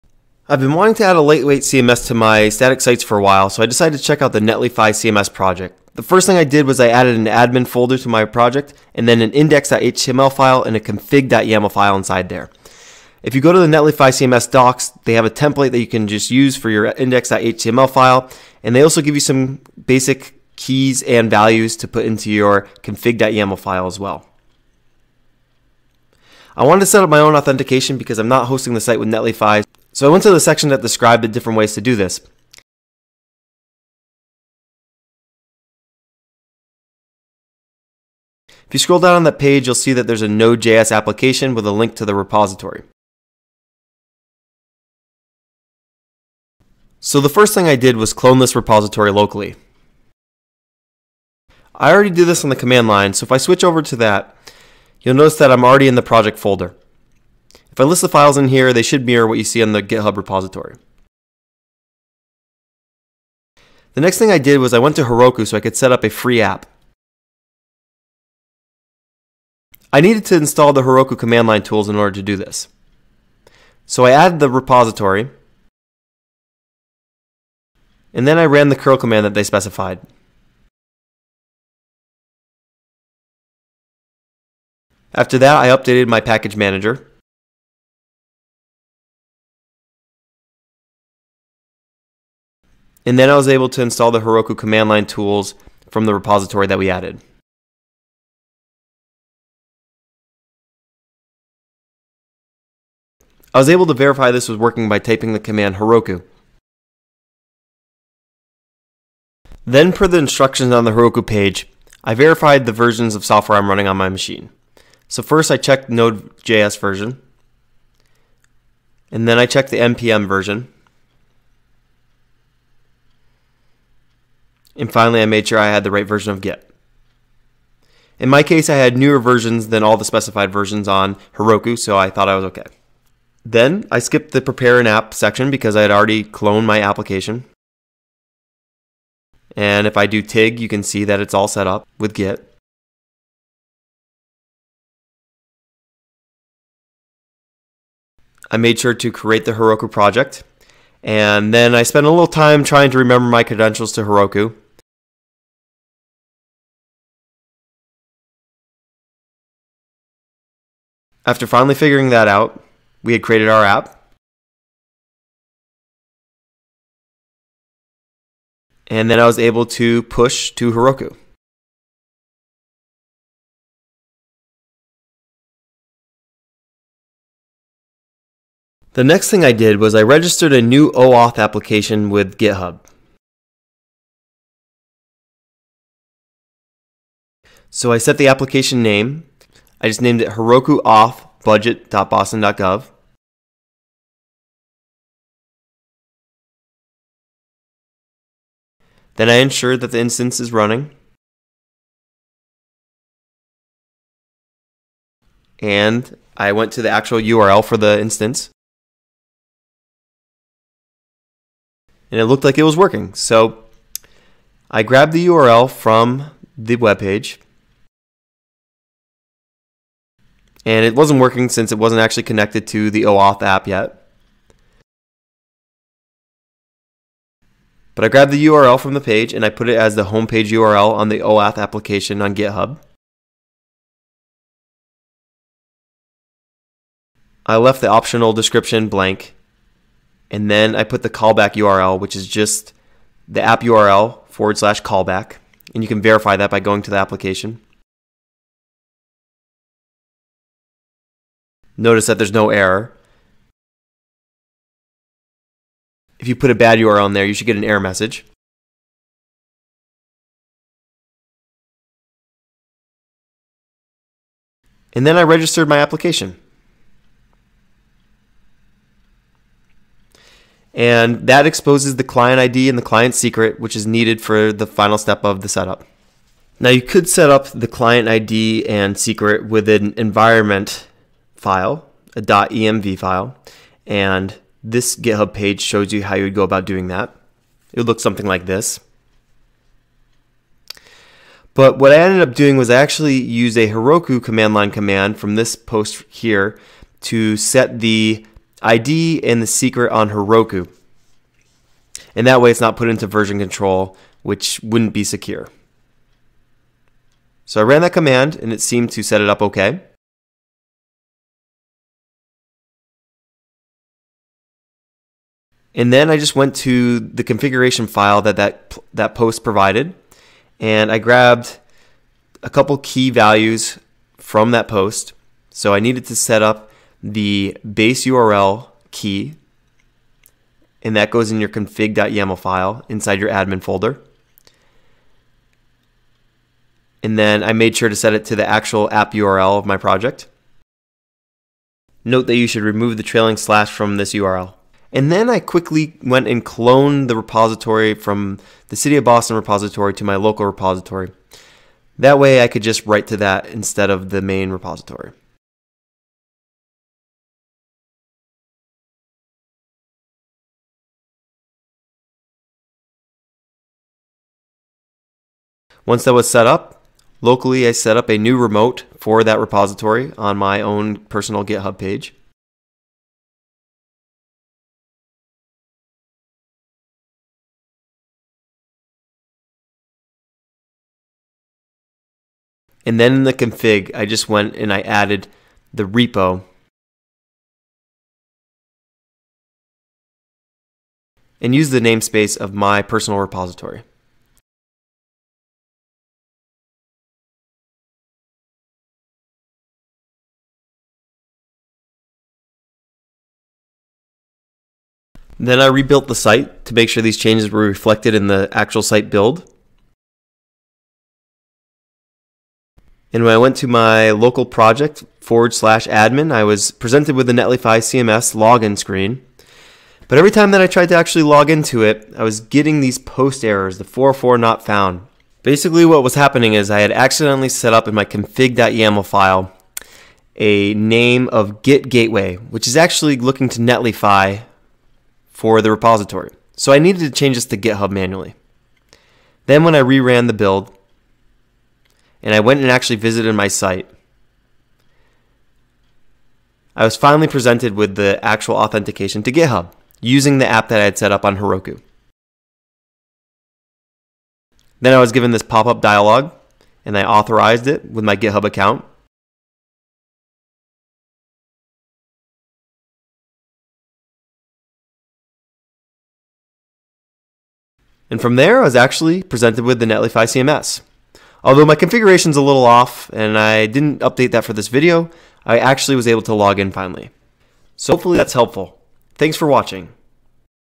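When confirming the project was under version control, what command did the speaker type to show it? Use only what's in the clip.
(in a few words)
TIG.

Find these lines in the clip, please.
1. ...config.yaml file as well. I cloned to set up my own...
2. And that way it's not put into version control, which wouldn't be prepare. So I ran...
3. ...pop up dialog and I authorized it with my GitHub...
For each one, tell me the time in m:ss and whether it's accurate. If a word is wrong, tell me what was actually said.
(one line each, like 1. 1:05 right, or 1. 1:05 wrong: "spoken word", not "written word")
1. 0:22 wrong: "wanted", not "cloned"
2. 5:02 wrong: "secure", not "prepare"
3. 7:35 right.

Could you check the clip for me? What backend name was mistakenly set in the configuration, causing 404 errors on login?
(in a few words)
git gateway.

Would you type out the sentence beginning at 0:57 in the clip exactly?
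If I list the files in here, they should mirror what you see on the GitHub repository.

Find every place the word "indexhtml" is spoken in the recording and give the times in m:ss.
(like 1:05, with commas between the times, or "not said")
0:09, 0:16.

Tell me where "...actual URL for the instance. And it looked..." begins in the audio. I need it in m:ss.
3:26.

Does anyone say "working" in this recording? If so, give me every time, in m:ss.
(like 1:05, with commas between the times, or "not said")
1:44, 3:32, 3:41.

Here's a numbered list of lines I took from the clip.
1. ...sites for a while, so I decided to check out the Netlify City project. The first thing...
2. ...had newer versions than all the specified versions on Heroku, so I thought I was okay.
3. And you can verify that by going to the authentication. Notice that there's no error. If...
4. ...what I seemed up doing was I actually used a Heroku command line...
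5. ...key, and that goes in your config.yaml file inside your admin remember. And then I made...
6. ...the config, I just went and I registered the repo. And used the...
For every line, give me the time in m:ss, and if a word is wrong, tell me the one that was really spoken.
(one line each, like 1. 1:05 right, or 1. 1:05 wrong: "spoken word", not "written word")
1. 0:02 wrong: "CMS", not "City"
2. 2:08 right
3. 4:05 wrong: "application", not "authentication"
4. 4:51 wrong: "ended", not "seemed"
5. 5:28 wrong: "folder", not "remember"
6. 6:23 wrong: "added", not "registered".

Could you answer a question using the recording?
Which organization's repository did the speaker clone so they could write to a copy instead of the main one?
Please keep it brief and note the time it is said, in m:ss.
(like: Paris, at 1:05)
City of Boston, at 5:48.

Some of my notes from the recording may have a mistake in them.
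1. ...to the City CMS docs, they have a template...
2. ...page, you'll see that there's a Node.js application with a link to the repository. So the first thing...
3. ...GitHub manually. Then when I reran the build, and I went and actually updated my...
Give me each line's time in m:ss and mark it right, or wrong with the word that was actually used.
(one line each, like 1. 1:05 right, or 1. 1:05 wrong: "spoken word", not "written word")
1. 0:13 wrong: "Netlify", not "City"
2. 0:39 right
3. 7:17 wrong: "visited", not "updated".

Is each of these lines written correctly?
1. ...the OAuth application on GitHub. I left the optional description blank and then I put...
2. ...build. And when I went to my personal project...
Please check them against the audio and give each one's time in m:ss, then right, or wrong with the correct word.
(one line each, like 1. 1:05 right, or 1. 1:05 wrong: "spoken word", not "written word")
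1. 3:51 right
2. 6:49 wrong: "local", not "personal".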